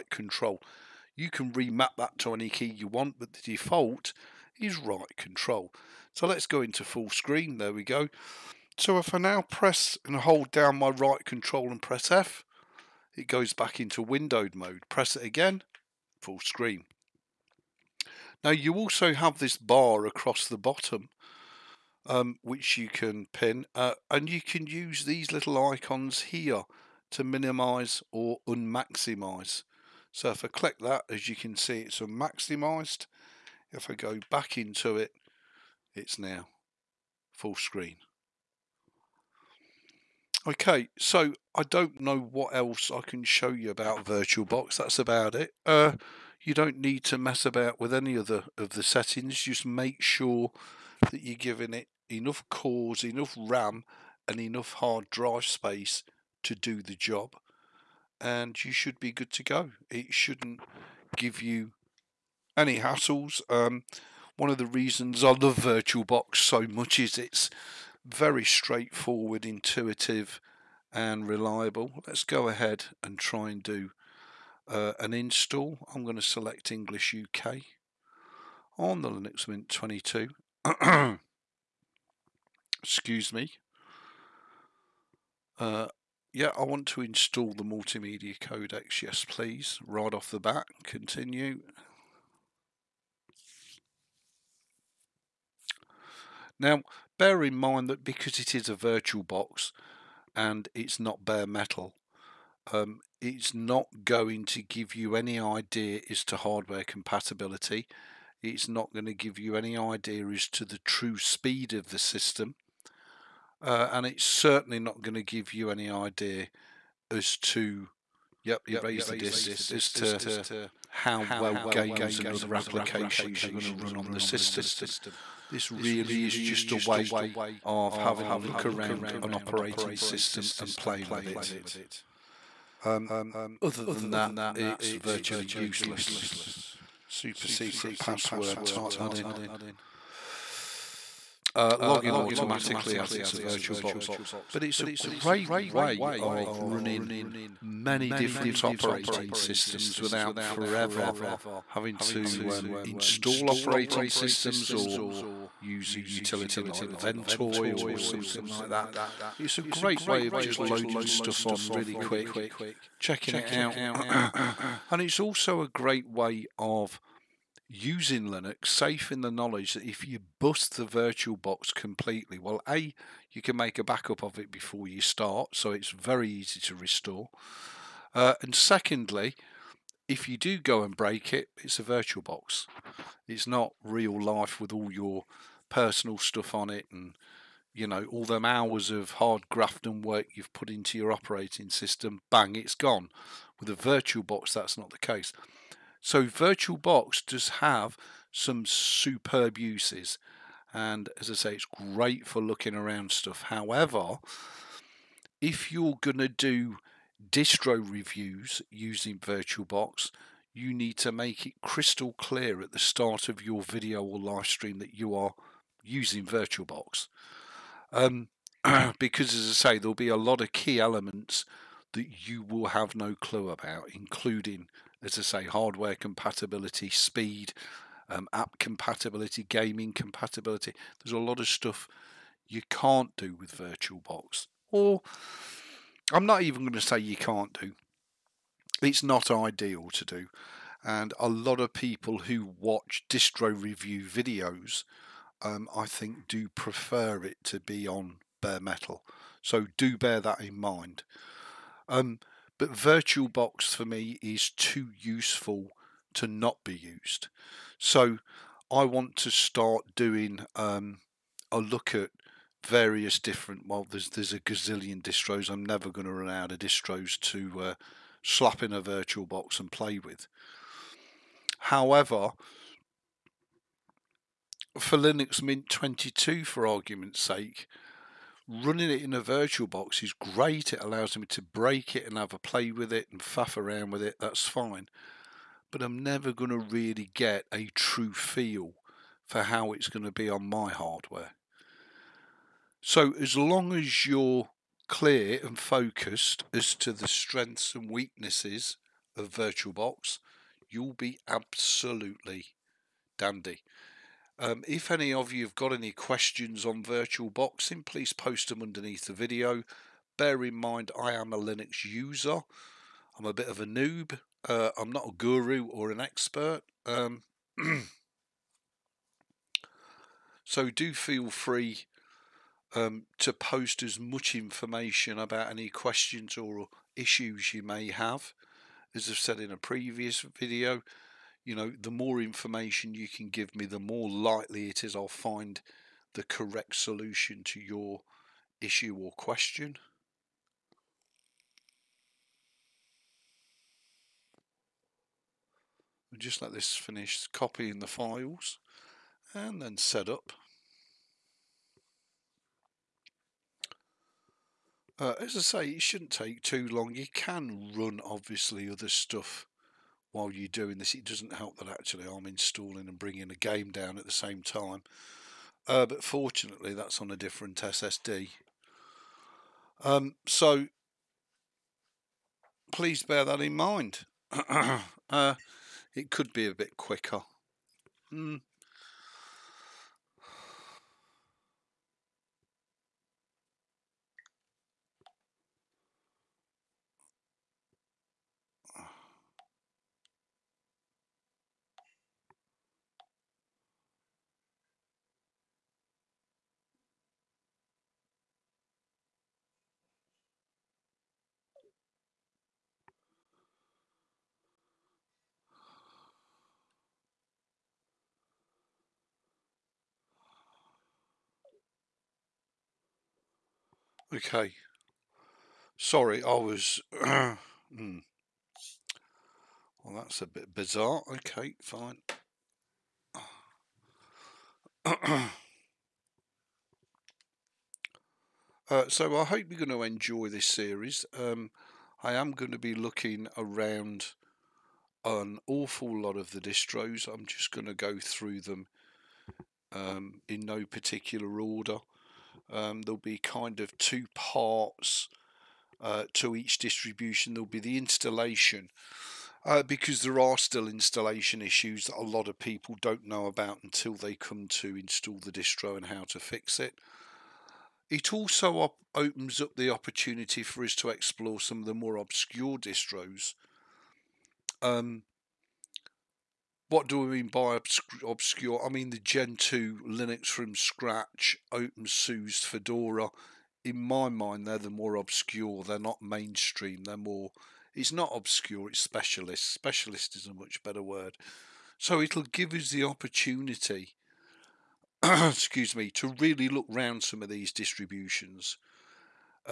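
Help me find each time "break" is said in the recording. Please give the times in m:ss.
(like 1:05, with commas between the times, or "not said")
3:00, 4:41.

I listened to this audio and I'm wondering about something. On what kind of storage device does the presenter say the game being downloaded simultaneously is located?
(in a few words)
A different SSD.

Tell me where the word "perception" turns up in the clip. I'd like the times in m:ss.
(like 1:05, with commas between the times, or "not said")
not said.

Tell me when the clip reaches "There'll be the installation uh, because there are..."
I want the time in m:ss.
7:27.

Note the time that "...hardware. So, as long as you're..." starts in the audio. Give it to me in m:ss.
4:50.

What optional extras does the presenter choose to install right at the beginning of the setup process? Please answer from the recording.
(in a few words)
Multimedia codecs.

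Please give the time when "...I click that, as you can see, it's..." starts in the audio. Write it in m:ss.
0:30.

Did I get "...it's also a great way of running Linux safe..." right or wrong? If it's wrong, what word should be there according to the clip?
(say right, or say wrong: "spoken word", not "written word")
wrong: "using", not "running".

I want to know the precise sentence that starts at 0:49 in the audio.
Just make sure that you're giving it enough cores, enough RAM, and enough hard drive space to do the job.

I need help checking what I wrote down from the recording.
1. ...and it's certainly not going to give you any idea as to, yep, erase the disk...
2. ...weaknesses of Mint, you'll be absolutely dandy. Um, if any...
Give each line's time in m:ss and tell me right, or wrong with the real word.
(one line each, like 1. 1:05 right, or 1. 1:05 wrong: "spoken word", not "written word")
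1. 1:53 right
2. 4:57 wrong: "VirtualBox", not "Mint".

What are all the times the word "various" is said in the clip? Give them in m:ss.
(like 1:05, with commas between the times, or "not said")
4:22.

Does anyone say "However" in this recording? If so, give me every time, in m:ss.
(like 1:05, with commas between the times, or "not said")
3:23, 4:31.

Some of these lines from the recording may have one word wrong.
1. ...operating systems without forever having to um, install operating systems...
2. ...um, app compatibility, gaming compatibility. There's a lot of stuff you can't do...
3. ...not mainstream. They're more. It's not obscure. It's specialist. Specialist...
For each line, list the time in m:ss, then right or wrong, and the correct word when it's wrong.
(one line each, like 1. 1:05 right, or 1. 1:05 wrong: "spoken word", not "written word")
1. 2:28 right
2. 3:48 right
3. 7:55 right.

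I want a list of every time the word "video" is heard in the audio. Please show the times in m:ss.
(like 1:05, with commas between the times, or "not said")
3:33, 4:04, 5:09, 5:30.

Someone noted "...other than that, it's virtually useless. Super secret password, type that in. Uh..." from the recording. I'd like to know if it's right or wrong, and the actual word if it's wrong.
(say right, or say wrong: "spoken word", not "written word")
right.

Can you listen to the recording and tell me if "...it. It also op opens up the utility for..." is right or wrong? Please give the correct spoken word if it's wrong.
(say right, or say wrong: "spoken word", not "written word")
wrong: "opportunity", not "utility".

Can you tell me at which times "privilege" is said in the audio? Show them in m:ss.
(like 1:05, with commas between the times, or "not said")
not said.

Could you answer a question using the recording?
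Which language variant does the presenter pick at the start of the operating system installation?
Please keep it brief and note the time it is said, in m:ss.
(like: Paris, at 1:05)
English UK, at 1:16.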